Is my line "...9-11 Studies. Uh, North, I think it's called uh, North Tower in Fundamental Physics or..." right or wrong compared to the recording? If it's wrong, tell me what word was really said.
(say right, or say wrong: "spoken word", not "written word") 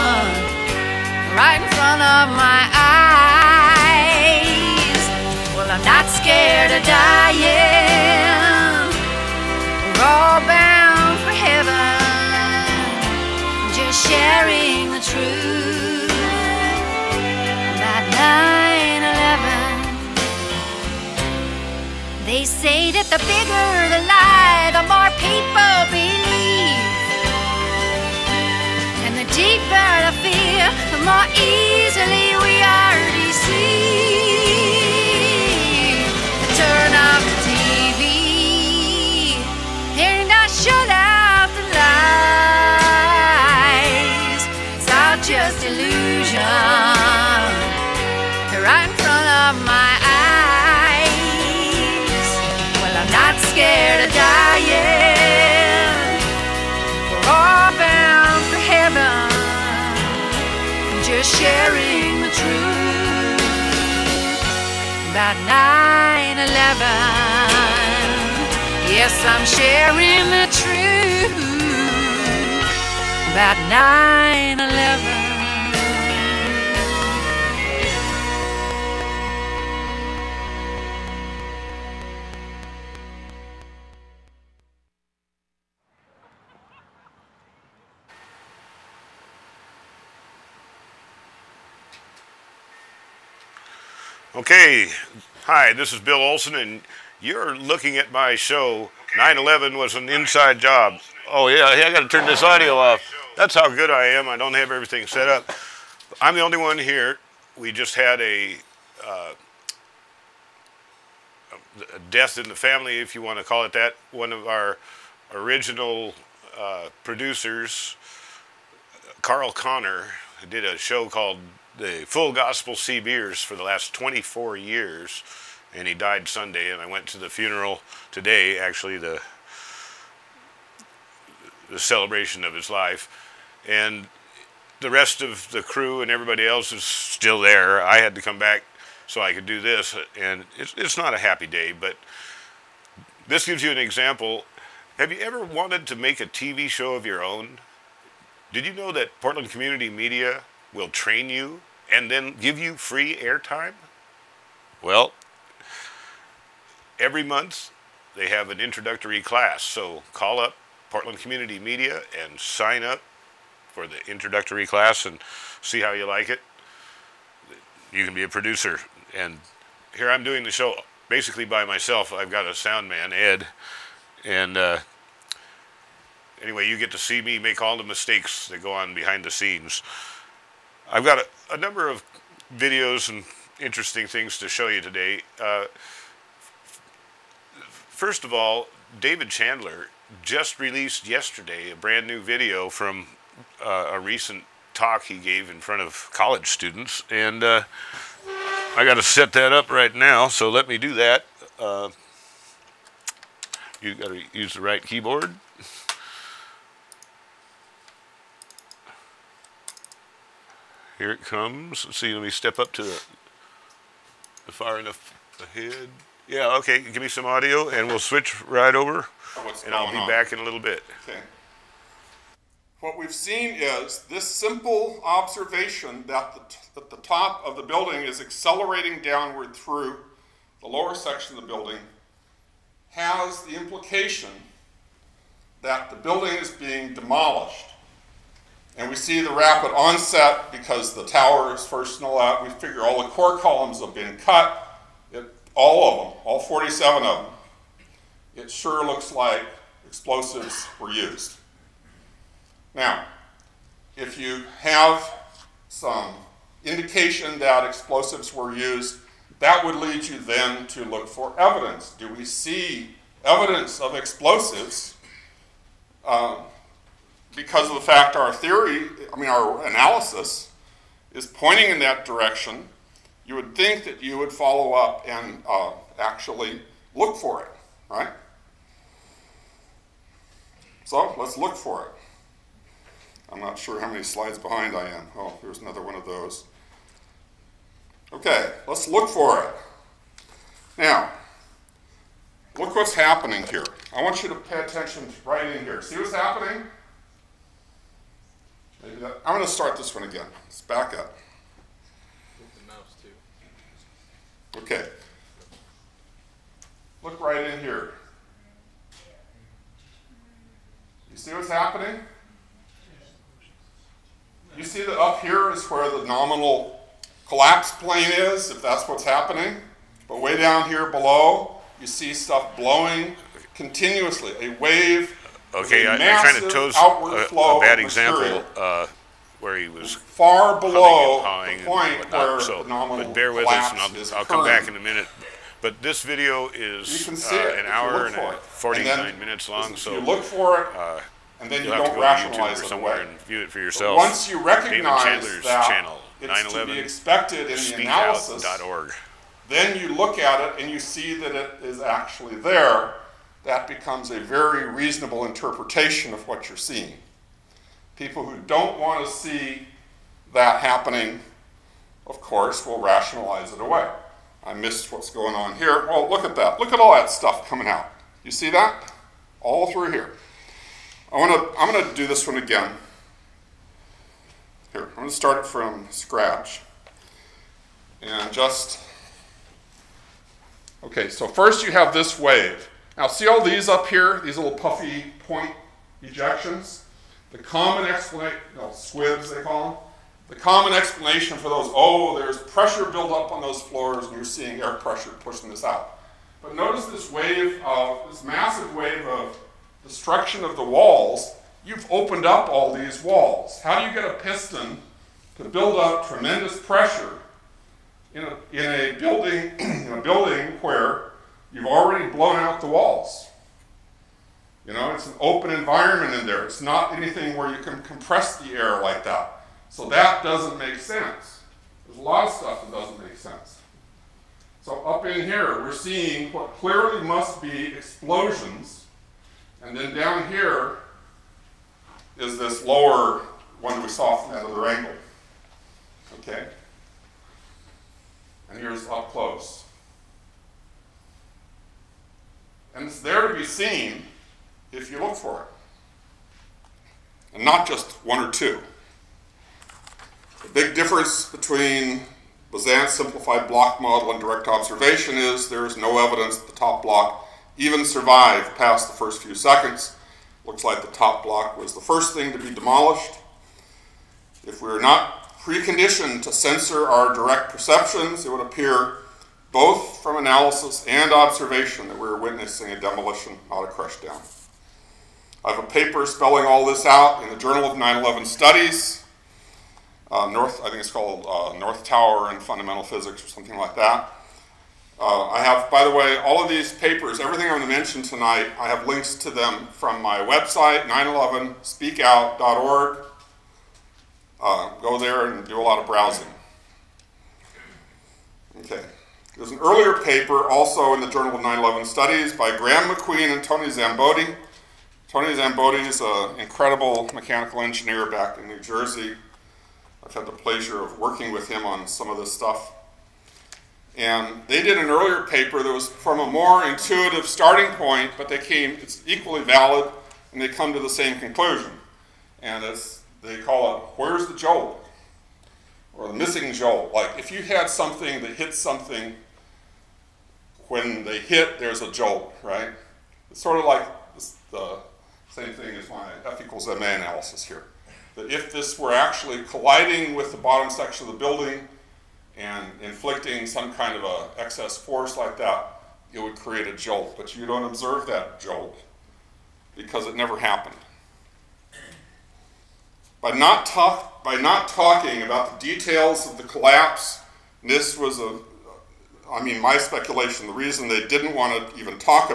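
right.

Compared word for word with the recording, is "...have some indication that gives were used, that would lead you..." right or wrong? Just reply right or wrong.
wrong.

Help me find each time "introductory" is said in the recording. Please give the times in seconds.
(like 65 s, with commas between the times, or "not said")
158 s, 164 s.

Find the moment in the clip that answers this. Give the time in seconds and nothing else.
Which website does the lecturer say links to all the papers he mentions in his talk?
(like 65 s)
490 s.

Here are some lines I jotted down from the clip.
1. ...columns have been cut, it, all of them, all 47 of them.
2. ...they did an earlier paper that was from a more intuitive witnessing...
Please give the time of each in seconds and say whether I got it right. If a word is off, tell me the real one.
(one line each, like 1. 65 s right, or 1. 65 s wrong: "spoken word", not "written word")
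1. 243 s right
2. 514 s wrong: "starting", not "witnessing".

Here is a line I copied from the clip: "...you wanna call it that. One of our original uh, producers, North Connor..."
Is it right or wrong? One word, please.
wrong.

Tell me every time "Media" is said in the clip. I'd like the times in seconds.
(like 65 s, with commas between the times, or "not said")
149 s, 161 s.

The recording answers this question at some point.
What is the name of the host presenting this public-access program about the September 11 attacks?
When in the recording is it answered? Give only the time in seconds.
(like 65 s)
95 s.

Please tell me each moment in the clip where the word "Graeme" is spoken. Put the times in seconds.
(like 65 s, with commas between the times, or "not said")
502 s.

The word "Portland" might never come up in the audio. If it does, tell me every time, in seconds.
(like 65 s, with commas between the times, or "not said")
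149 s, 160 s.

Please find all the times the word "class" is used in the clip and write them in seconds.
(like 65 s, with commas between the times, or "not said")
159 s, 164 s.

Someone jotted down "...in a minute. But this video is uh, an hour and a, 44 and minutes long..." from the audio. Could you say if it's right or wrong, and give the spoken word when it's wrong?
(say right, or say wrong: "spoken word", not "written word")
wrong: "49", not "44".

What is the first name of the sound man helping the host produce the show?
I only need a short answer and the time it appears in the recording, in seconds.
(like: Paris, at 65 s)
Ed, at 173 s.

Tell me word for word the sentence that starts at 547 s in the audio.
But you don't observe that jolt because it never happened.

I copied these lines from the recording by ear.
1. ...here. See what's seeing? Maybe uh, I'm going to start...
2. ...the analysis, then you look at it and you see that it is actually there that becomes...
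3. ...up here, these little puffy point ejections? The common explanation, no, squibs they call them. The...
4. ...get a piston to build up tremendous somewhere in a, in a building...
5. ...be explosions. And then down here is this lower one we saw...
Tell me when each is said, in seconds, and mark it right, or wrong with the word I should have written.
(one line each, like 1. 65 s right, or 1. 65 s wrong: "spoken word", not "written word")
1. 295 s wrong: "happening", not "seeing"
2. 347 s right
3. 383 s right
4. 403 s wrong: "pressure", not "somewhere"
5. 427 s right.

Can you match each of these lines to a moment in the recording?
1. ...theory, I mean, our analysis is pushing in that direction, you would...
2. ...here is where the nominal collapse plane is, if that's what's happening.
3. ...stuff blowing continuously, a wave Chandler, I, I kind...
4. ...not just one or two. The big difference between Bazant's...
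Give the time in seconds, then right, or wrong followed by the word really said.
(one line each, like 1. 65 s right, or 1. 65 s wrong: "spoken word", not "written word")
1. 268 s wrong: "pointing", not "pushing"
2. 315 s right
3. 322 s wrong: "Okay", not "Chandler"
4. 447 s right.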